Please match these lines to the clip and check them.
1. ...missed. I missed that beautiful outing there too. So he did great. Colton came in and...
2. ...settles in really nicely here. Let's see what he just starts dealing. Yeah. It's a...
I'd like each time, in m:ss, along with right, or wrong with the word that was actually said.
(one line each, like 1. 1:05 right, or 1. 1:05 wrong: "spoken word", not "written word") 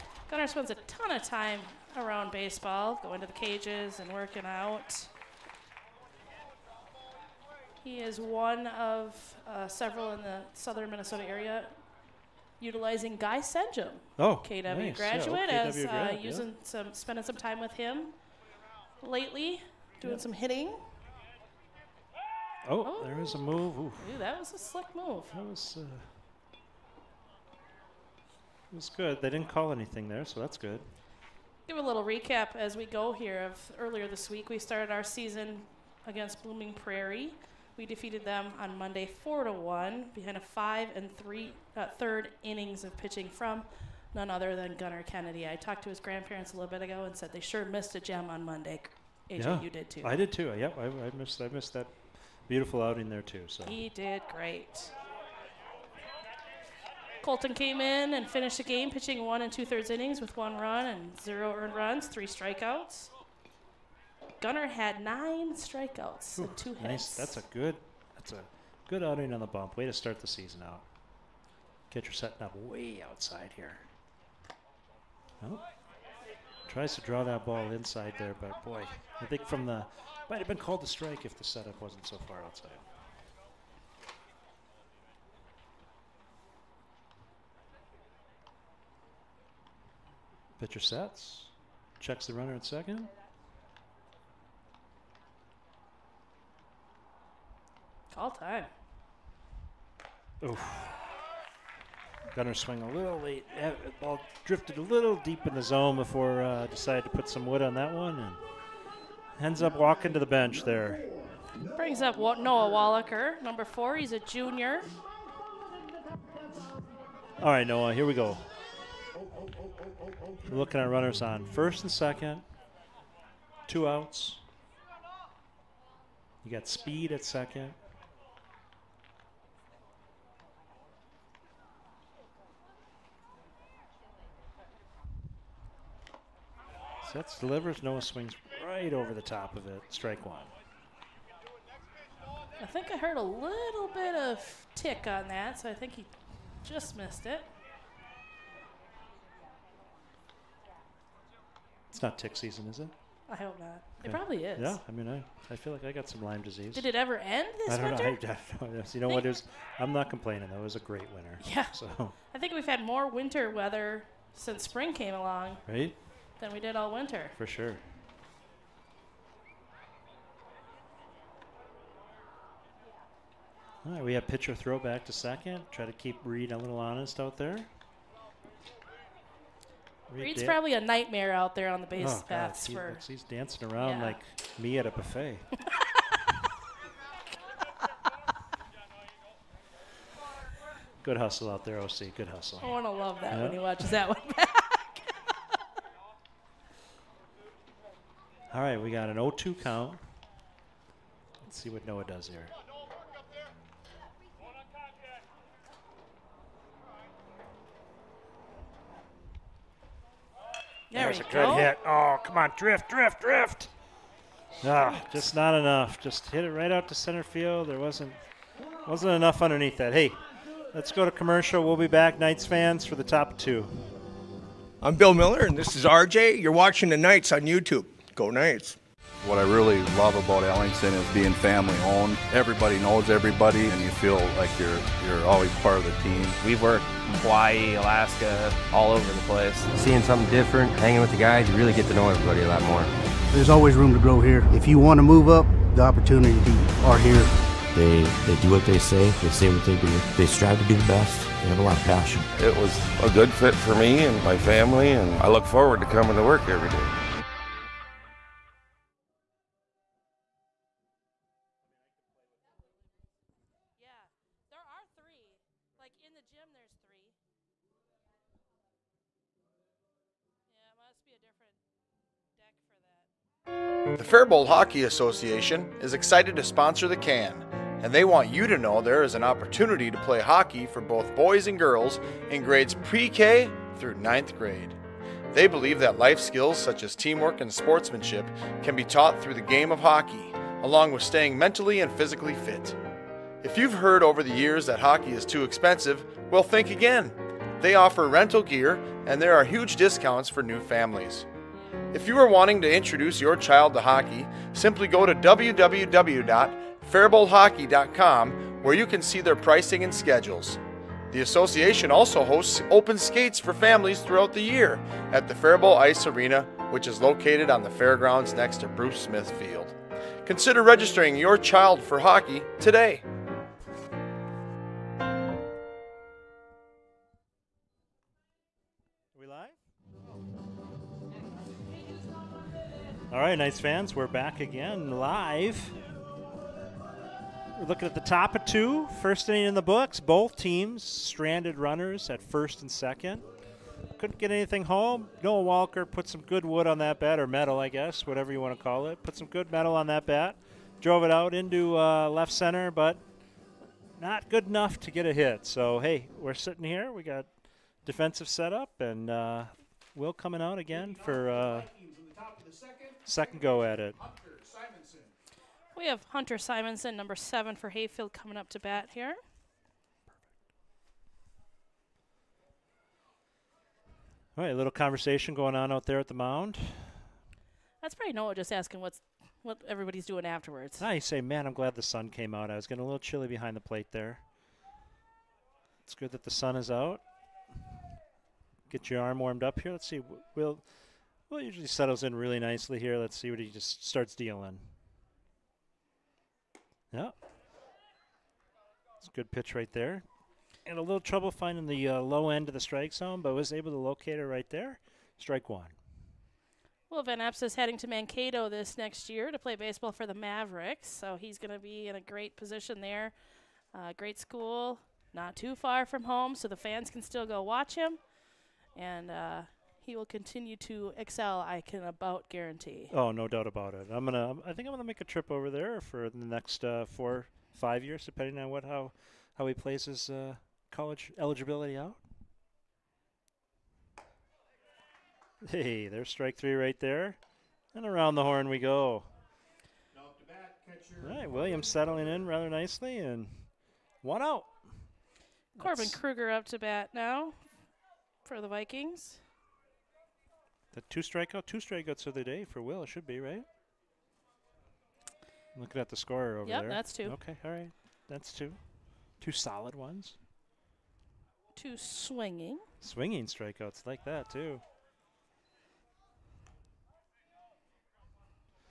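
1. 0:51 right
2. 6:31 right.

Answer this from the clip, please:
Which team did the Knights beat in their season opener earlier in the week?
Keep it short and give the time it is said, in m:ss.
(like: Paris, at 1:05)
Blooming Prairie, at 0:36.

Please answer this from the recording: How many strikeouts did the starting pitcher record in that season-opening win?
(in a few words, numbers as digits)
9.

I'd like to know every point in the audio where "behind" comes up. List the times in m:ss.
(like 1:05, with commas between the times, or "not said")
0:40, 6:23.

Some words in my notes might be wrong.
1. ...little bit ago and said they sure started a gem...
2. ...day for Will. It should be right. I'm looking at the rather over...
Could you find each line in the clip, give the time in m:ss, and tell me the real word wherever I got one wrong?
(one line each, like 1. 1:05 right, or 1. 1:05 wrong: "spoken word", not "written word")
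1. 0:46 wrong: "missed", not "started"
2. 7:32 wrong: "scorer", not "rather".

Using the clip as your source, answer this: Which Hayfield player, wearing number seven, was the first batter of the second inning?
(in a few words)
Hunter Simonson.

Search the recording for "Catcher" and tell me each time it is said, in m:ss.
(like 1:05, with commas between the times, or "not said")
1:11.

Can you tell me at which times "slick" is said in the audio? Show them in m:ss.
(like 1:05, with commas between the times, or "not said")
0:24.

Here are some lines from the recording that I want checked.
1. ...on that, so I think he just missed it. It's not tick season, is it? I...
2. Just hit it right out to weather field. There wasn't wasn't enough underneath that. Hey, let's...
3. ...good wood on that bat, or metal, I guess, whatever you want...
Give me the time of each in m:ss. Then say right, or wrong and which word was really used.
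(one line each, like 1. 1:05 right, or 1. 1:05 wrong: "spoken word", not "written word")
1. 2:25 right
2. 3:36 wrong: "center", not "weather"
3. 5:46 right.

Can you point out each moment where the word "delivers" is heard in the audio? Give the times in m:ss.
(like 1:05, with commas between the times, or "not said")
2:17.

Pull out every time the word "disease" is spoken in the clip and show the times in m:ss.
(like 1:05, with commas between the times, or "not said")
2:36.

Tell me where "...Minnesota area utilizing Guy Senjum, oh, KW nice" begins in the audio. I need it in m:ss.
0:10.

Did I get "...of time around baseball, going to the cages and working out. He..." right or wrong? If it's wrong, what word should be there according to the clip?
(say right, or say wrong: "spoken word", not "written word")
right.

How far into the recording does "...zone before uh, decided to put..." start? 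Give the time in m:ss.
1:45.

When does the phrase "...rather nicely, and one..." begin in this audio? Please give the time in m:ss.
7:22.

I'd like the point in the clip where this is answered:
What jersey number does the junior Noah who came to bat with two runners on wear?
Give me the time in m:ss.
1:53.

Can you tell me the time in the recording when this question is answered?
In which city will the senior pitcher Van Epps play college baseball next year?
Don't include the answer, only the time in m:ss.
6:47.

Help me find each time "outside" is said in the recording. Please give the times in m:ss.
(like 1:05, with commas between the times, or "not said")
1:13, 1:22.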